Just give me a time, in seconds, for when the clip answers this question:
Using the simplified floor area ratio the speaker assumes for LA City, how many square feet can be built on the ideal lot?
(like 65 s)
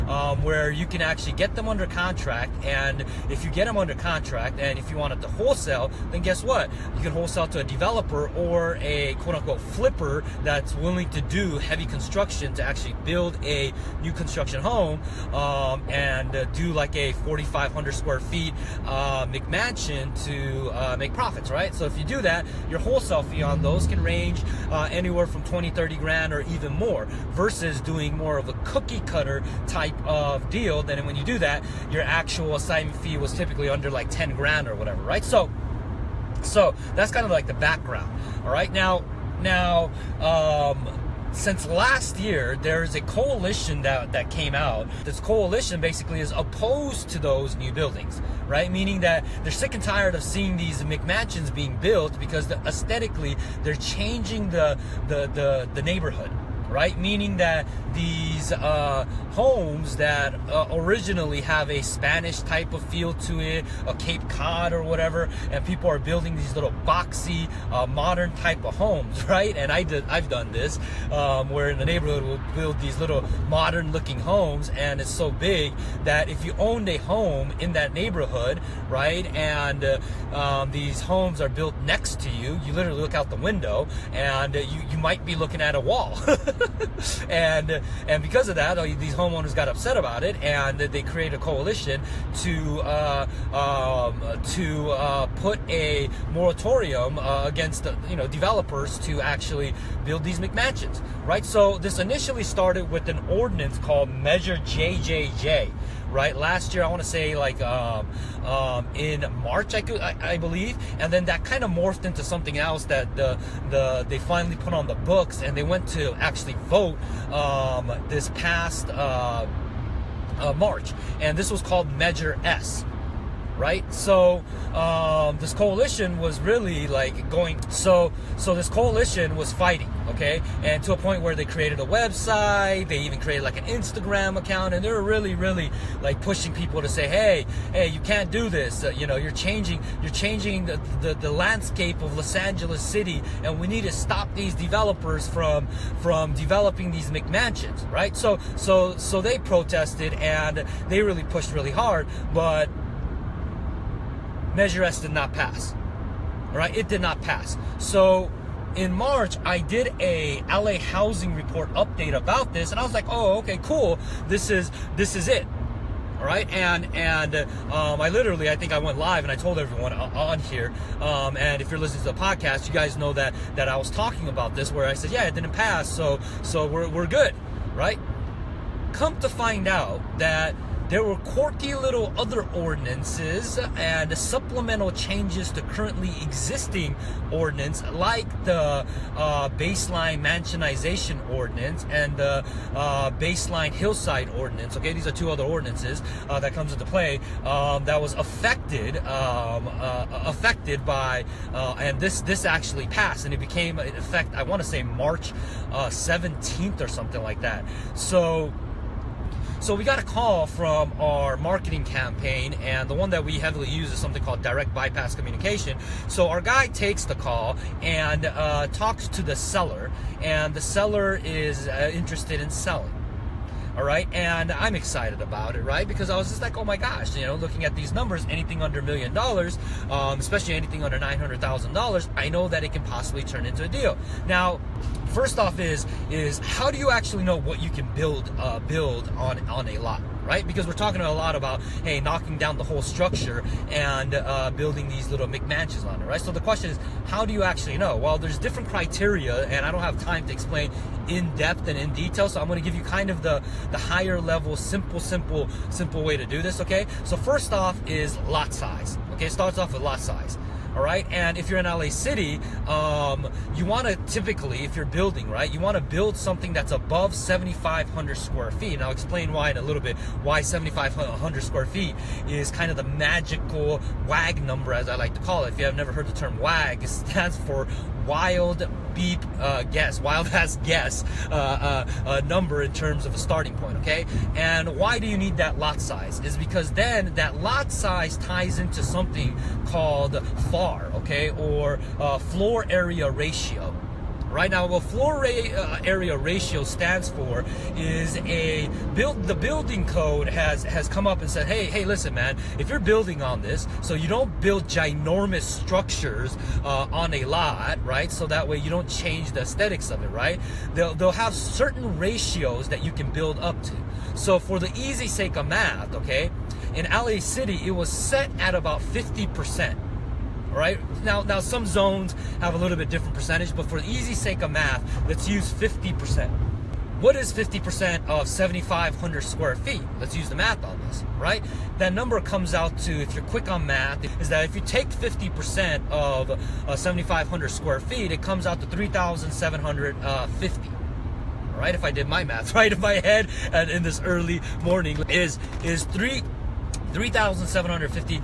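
338 s.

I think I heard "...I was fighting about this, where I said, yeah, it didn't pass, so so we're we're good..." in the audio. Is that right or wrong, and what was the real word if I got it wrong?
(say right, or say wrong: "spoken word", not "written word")
wrong: "talking", not "fighting".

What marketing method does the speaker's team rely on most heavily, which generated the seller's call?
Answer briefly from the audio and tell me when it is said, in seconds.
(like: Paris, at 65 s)
direct bypass communication, at 214 s.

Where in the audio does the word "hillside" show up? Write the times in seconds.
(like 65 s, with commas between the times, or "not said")
193 s.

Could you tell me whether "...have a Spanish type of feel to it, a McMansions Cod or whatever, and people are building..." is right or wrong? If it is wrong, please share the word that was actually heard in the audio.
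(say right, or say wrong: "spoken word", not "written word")
wrong: "Cape", not "McMansions".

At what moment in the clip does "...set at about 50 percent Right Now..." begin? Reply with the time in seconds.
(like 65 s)
317 s.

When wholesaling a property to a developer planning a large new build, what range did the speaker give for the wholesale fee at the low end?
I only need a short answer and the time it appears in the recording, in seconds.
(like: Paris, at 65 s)
20, 30 grand, at 25 s.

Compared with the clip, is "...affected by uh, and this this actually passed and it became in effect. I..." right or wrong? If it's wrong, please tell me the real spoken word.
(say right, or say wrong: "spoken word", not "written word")
right.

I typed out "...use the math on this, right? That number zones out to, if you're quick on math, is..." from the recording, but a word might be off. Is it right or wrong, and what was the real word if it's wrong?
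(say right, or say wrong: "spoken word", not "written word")
wrong: "comes", not "zones".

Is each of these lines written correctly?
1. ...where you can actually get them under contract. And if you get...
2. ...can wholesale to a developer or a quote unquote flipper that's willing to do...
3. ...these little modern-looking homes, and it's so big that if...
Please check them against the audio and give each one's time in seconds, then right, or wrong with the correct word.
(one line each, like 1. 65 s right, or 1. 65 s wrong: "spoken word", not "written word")
1. 0 s right
2. 7 s right
3. 72 s right.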